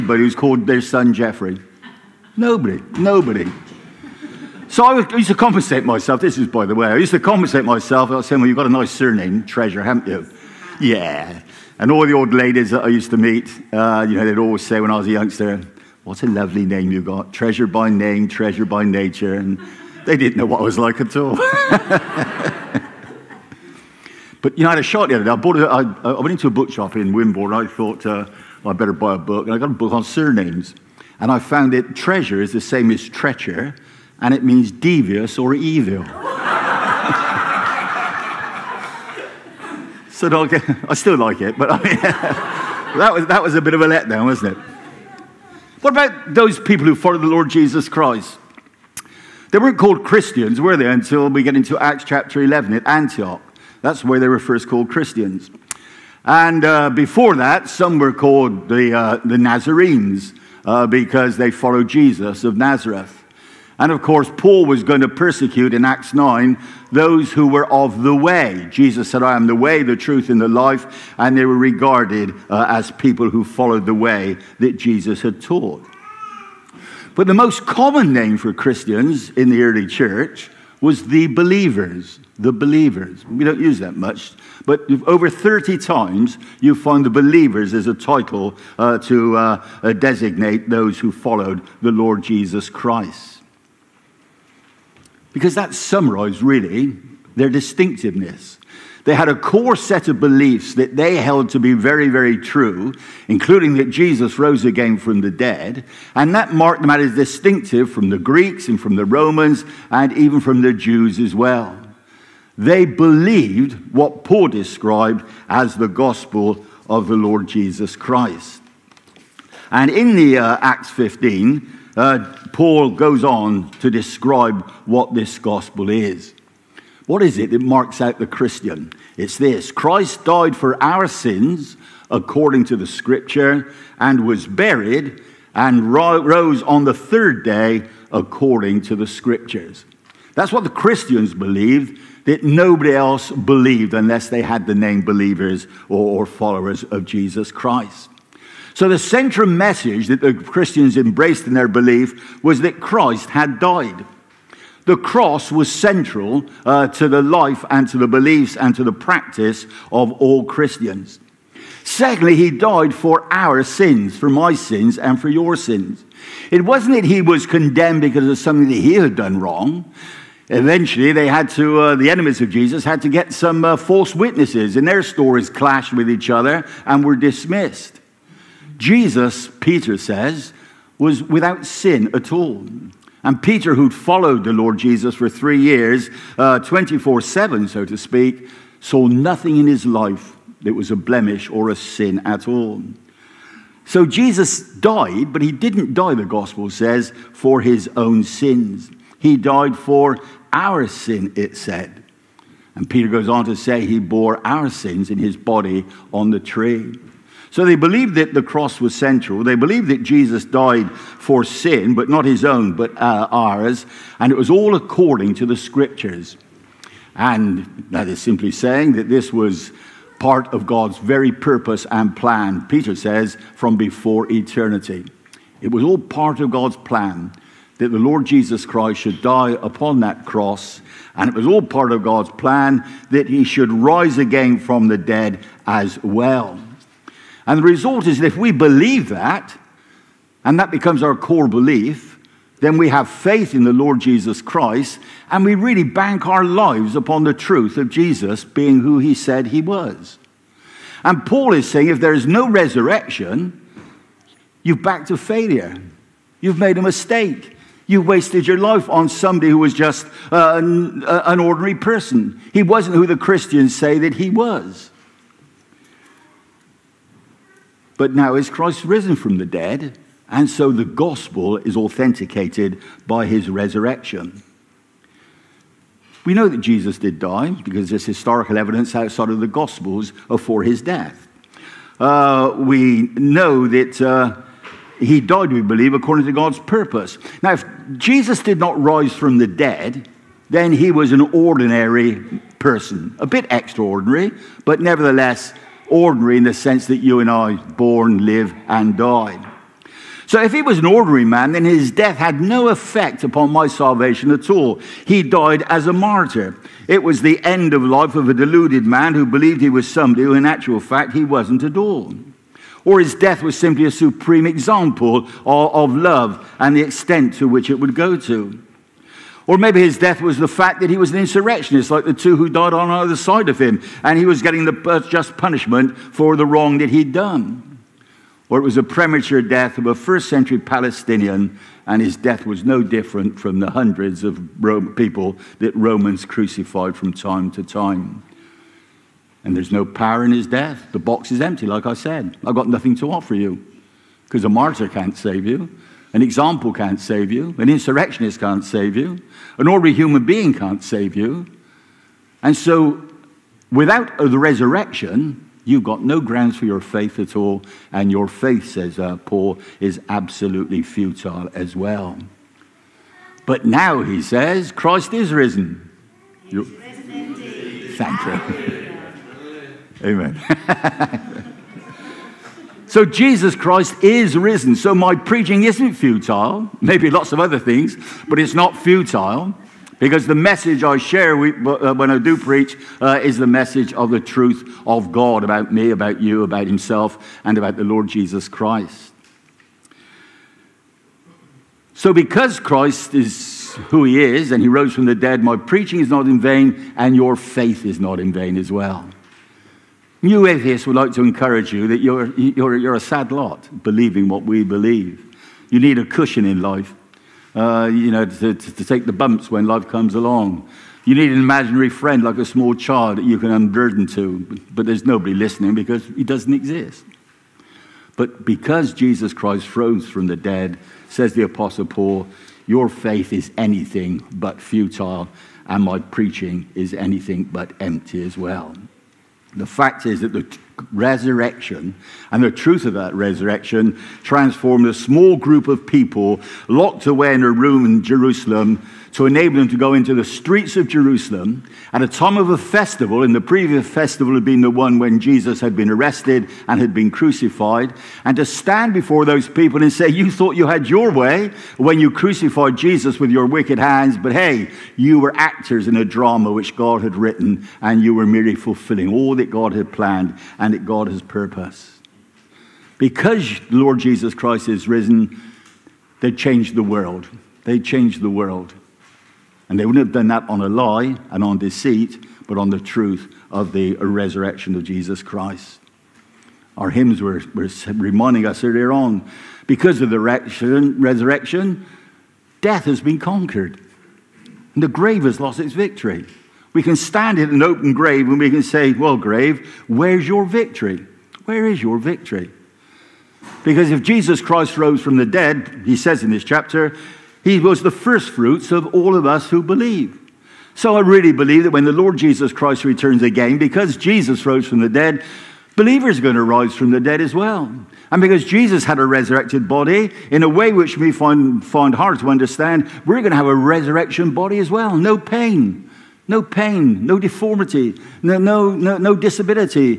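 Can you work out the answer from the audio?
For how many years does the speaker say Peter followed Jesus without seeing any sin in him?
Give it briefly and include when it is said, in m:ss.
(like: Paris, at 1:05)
3, at 3:05.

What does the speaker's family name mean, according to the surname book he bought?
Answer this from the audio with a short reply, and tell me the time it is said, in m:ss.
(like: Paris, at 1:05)
devious or evil, at 0:34.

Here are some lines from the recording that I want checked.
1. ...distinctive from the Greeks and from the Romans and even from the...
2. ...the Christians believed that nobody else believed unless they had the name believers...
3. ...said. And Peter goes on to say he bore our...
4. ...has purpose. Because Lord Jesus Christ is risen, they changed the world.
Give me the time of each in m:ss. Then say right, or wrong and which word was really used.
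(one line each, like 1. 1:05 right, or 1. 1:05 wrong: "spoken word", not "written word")
1. 1:47 right
2. 2:20 right
3. 3:21 right
4. 7:41 right.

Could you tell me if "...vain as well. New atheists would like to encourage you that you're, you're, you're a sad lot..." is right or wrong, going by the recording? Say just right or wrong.
right.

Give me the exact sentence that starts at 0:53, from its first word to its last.
That's the way they were first called Christians.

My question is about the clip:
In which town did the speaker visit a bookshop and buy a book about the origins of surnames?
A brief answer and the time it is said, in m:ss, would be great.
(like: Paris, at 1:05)
Wimborne, at 0:27.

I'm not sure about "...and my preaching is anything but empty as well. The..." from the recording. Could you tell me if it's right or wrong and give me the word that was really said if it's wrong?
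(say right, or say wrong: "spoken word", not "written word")
right.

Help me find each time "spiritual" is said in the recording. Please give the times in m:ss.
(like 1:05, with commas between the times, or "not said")
not said.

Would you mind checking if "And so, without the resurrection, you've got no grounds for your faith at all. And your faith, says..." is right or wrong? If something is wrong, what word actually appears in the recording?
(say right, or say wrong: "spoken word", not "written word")
right.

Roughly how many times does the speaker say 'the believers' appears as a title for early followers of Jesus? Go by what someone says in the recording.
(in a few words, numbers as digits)
over 30.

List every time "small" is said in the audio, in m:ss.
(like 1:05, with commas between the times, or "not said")
6:52, 7:14.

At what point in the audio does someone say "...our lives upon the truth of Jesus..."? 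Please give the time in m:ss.
4:06.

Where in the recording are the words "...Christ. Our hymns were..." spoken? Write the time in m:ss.
7:55.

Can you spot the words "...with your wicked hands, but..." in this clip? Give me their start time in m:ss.
7:33.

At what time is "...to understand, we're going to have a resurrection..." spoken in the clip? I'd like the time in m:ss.
8:32.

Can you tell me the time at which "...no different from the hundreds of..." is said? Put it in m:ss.
5:32.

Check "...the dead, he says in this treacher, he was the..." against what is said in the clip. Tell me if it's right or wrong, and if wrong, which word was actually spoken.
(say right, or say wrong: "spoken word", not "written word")
wrong: "chapter", not "treacher".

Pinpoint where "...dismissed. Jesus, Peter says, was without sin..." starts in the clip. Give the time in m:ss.
2:57.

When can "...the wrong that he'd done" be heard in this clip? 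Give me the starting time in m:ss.
5:26.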